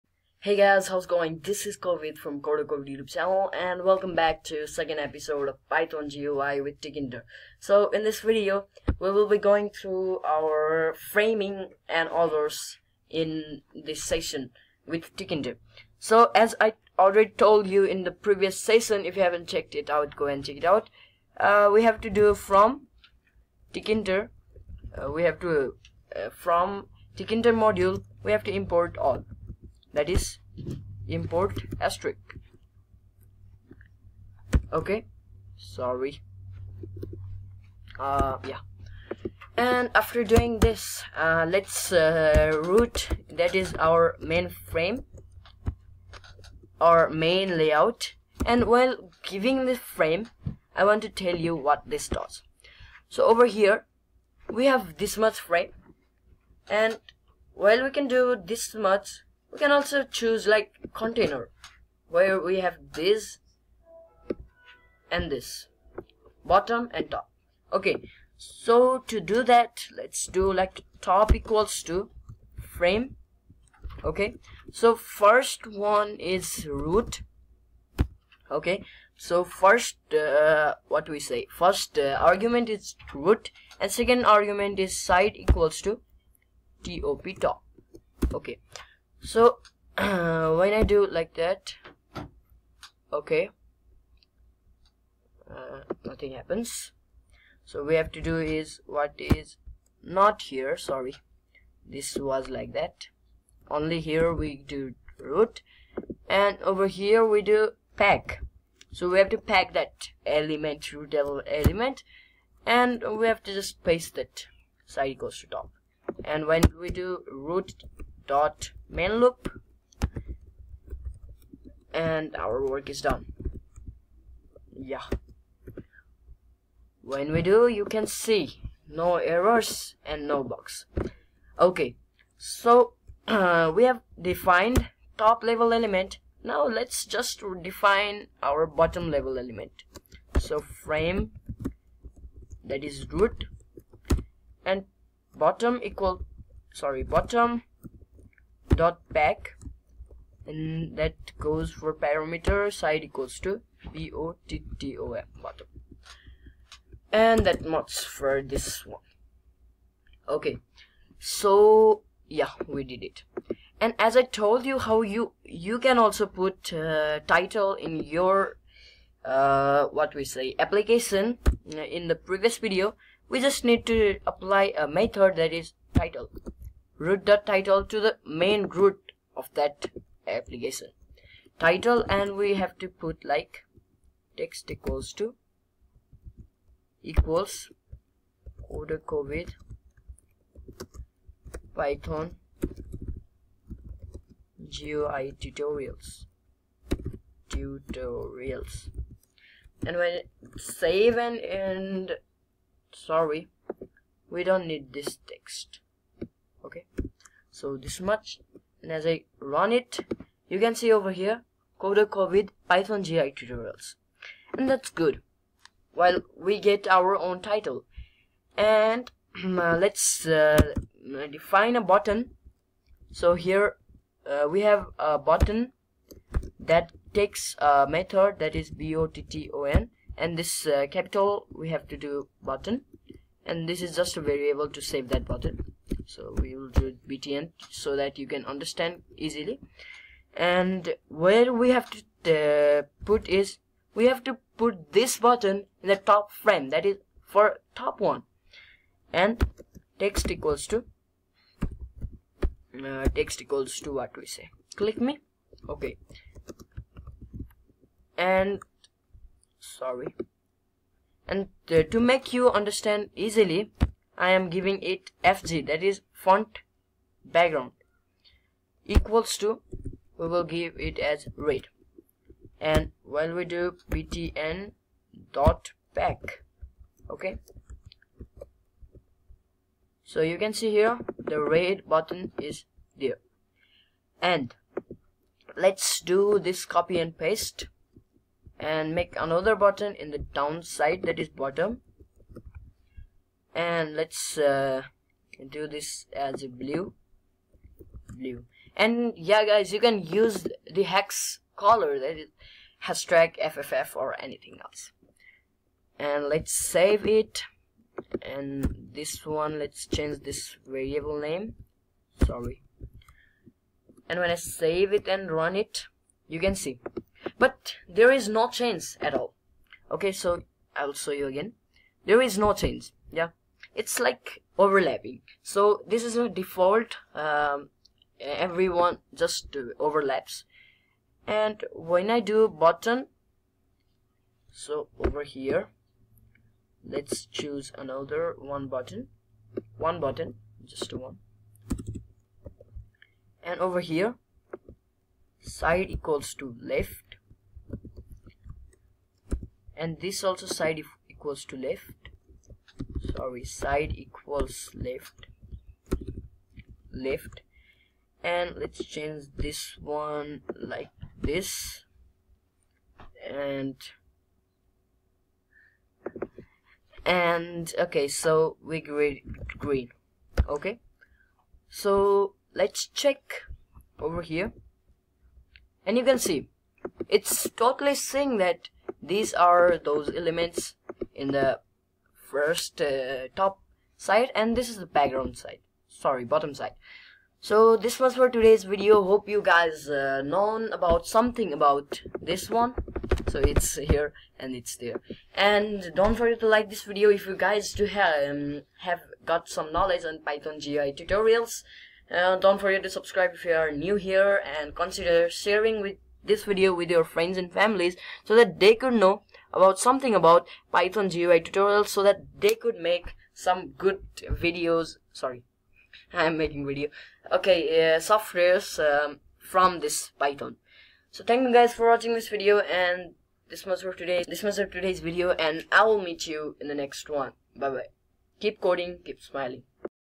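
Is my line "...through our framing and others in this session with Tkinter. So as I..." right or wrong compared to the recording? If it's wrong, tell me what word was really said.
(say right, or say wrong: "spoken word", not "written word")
right.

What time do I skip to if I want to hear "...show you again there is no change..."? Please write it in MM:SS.
05:20.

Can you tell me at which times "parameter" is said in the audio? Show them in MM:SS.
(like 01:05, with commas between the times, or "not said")
02:31.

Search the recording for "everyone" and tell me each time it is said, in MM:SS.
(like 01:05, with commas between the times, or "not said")
05:28.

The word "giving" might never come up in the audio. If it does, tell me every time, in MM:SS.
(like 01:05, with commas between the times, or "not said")
00:49, 04:24.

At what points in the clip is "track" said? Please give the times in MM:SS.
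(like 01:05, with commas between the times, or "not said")
05:03.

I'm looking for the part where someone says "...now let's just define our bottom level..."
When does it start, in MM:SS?
02:16.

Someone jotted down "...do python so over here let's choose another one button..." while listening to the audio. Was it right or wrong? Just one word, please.
wrong.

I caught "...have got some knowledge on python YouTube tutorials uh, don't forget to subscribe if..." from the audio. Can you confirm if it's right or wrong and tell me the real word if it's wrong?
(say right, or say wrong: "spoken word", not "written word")
wrong: "GUI", not "YouTube".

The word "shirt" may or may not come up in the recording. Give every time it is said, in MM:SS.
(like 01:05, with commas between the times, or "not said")
not said.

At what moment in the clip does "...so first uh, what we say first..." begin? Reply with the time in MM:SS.
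01:19.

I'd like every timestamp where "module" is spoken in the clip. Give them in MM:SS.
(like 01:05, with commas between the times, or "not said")
00:27.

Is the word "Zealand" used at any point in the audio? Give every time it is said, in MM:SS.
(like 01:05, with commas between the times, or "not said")
not said.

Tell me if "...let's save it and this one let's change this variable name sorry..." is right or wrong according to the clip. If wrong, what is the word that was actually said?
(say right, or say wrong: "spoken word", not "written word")
right.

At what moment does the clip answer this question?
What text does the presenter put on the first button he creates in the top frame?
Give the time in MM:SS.
04:14.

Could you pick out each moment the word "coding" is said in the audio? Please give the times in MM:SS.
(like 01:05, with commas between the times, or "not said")
07:08.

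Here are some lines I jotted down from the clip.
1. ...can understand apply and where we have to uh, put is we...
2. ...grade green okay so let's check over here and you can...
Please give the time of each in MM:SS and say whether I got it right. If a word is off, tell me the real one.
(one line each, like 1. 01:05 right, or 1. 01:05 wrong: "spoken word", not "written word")
1. 03:58 wrong: "easily", not "apply"
2. 06:08 right.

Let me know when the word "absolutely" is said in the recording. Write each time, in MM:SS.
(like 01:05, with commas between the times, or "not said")
not said.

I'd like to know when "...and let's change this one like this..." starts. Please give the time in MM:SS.
05:58.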